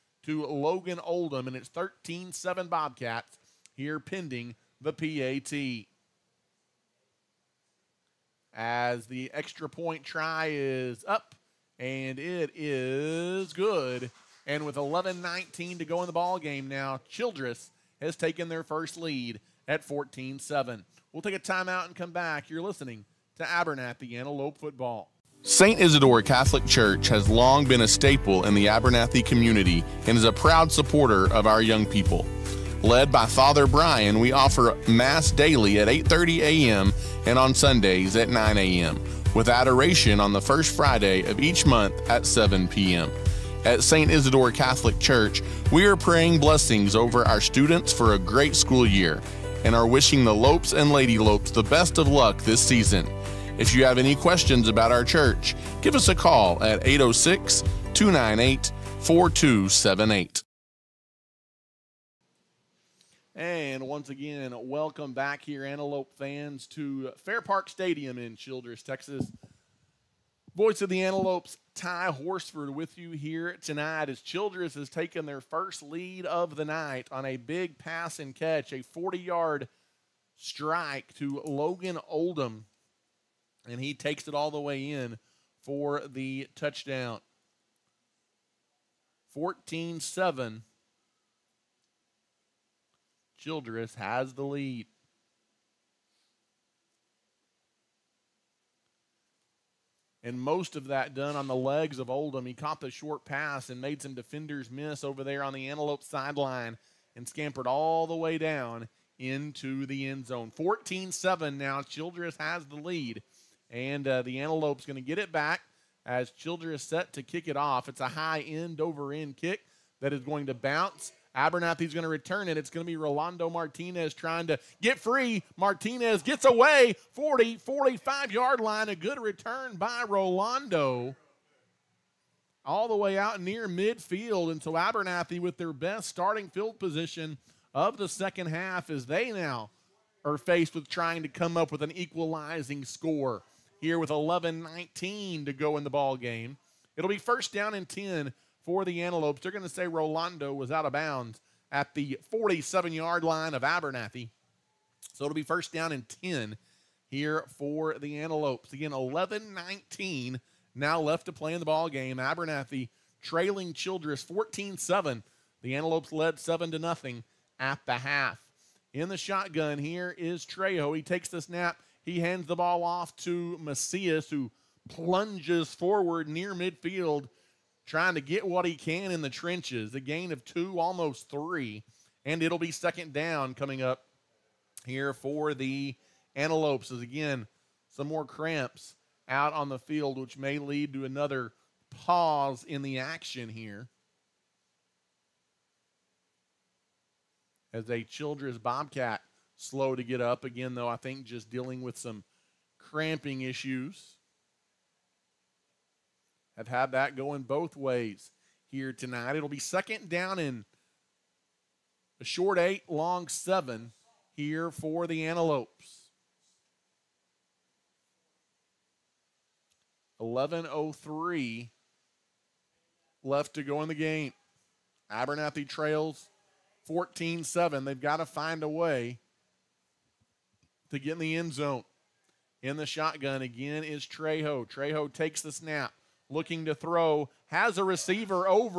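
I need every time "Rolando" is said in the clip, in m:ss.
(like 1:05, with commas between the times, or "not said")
2:02, 2:10, 2:29.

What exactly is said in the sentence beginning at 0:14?
And with 11 19 to go in the ball game now, Childress has taken their first lead at 14 7.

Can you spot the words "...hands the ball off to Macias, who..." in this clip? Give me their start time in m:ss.
2:52.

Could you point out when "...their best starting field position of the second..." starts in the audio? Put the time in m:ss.
2:15.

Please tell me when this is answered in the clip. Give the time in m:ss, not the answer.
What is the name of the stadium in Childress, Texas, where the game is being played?
1:07.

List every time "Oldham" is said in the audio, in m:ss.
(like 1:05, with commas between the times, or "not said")
0:01, 1:22, 1:42.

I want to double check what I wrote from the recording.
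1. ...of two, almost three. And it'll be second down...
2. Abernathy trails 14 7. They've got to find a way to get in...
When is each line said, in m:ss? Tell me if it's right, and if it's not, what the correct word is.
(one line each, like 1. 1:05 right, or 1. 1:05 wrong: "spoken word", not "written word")
1. 3:00 right
2. 3:45 right.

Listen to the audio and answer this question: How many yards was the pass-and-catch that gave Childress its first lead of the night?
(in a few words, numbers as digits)
40.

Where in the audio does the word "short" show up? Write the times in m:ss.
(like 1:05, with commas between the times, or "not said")
1:42, 3:32.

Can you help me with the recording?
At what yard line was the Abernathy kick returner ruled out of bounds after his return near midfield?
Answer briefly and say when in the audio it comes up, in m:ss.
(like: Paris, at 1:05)
47, at 2:32.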